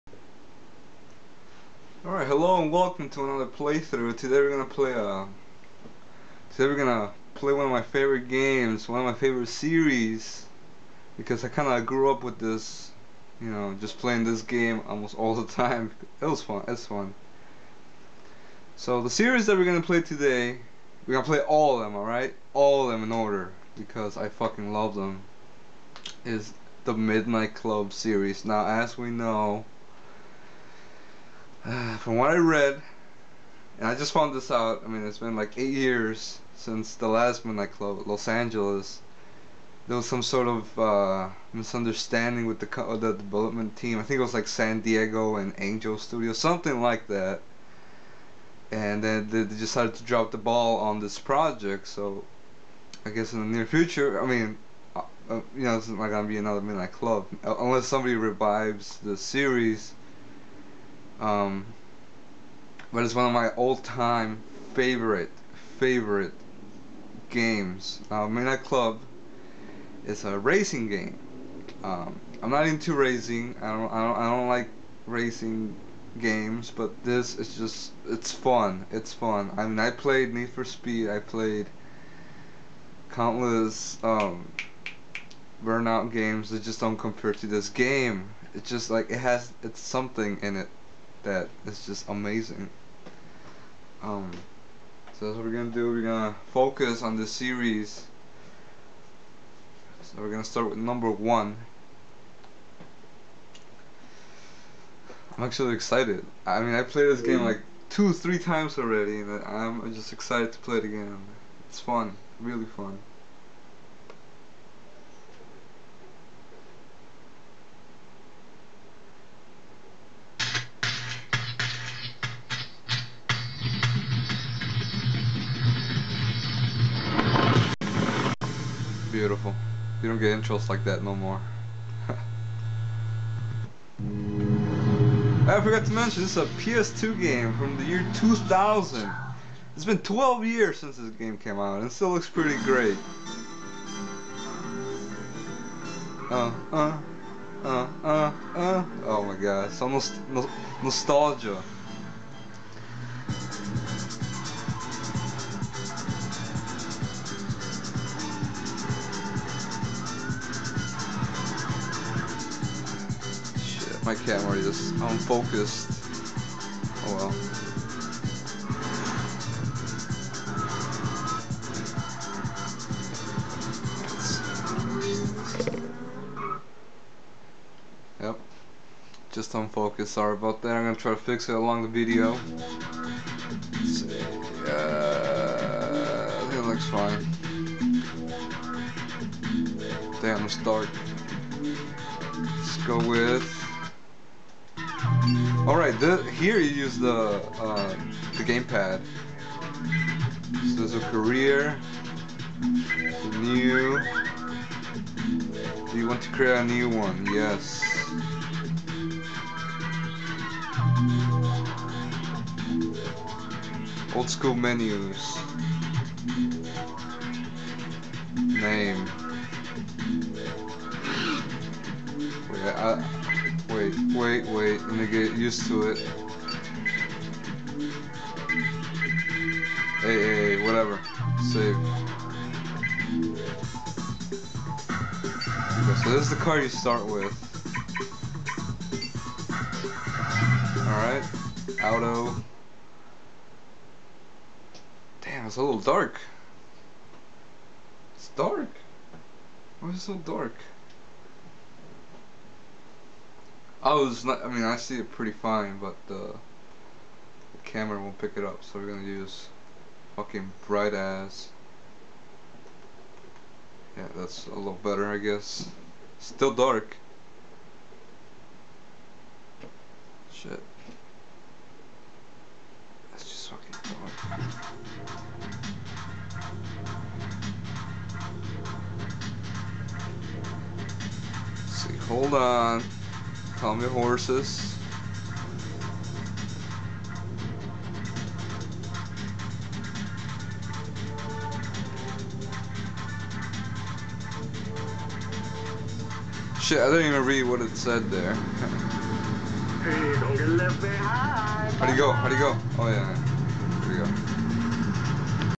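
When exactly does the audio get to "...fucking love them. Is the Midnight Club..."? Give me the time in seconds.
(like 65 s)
24 s.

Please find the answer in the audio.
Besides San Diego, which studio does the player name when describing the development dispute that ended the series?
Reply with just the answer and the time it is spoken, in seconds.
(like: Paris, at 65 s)
Angel Studios, at 45 s.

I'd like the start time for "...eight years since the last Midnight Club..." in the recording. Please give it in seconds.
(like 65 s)
35 s.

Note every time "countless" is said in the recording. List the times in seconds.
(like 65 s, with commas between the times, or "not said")
83 s.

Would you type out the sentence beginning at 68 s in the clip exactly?
Now, Club is a racing game.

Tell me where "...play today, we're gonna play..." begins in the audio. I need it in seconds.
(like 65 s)
19 s.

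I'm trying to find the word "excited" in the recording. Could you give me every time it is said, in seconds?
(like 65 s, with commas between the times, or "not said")
105 s, 110 s.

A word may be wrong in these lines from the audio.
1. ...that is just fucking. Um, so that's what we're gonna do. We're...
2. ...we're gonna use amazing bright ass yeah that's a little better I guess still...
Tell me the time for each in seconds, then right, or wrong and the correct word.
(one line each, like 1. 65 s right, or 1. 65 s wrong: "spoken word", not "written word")
1. 91 s wrong: "amazing", not "fucking"
2. 258 s wrong: "fucking", not "amazing".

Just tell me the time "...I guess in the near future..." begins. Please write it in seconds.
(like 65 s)
53 s.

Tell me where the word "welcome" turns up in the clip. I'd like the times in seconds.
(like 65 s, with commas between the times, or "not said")
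2 s.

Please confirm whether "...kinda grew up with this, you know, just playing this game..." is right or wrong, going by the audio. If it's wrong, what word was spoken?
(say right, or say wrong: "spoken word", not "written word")
right.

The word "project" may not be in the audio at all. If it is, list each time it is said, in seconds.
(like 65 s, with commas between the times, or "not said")
51 s.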